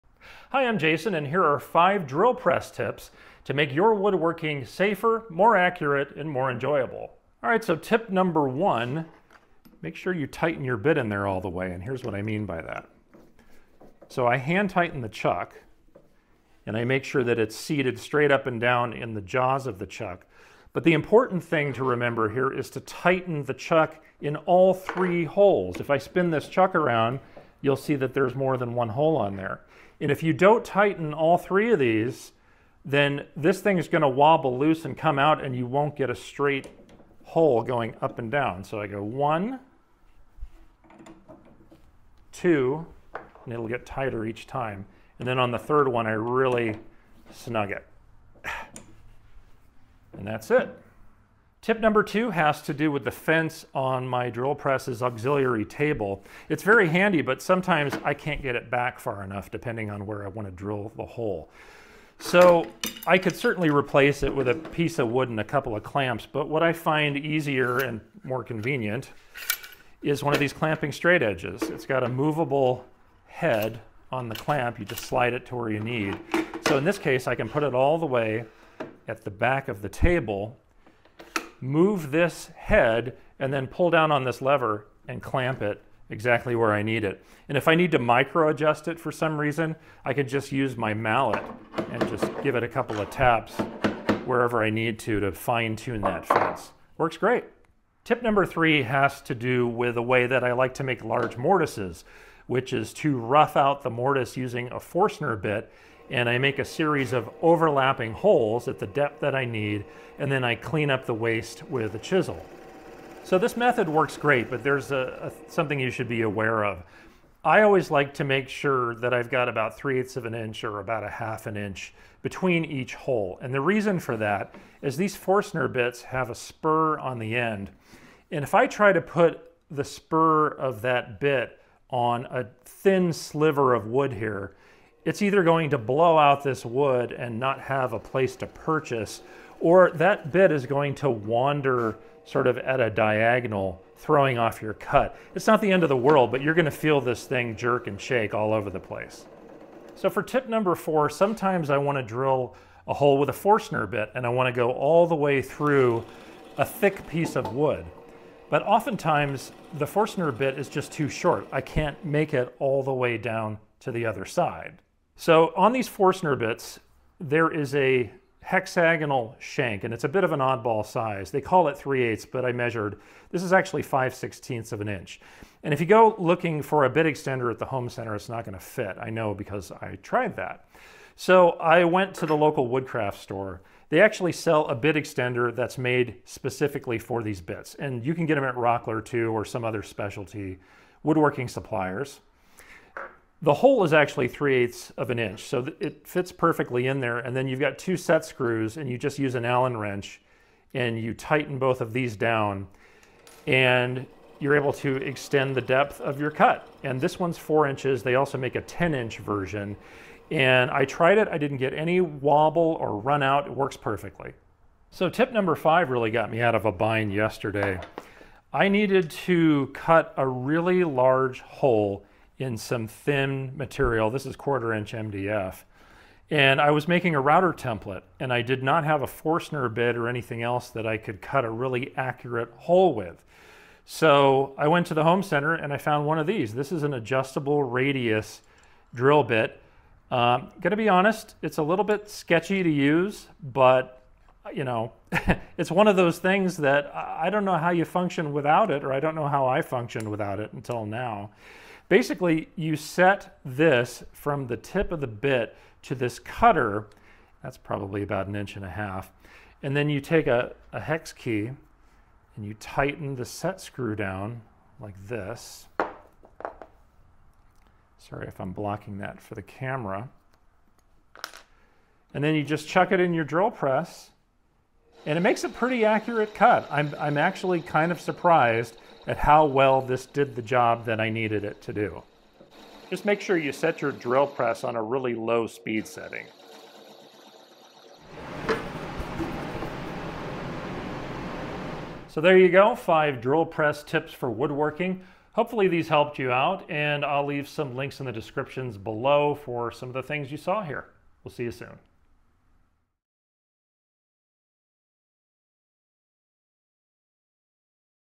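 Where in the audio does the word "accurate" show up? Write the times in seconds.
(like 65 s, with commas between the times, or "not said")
5 s, 231 s, 275 s.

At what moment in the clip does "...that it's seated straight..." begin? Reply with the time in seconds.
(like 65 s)
17 s.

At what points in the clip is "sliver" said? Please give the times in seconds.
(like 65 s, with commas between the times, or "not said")
133 s.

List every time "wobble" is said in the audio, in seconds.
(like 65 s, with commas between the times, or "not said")
34 s, 211 s.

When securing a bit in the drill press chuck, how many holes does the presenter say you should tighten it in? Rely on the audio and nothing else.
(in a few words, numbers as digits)
3.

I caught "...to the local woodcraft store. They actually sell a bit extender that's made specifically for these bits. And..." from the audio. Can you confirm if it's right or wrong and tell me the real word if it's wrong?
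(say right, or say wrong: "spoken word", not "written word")
right.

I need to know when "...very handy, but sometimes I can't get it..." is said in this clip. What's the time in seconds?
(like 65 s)
56 s.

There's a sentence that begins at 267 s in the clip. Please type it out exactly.
Sorry if I'm blocking that for the camera.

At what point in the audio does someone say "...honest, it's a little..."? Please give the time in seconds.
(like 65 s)
240 s.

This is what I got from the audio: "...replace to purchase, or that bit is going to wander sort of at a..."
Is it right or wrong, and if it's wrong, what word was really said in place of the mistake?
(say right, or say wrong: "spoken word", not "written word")
wrong: "place", not "replace".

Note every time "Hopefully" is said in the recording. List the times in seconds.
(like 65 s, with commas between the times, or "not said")
295 s.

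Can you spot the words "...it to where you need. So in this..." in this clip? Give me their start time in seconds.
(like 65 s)
75 s.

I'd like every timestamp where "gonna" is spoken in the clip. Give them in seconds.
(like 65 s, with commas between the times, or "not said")
146 s, 240 s.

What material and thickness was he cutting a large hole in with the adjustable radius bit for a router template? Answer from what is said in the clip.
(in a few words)
1/4 inch MDF.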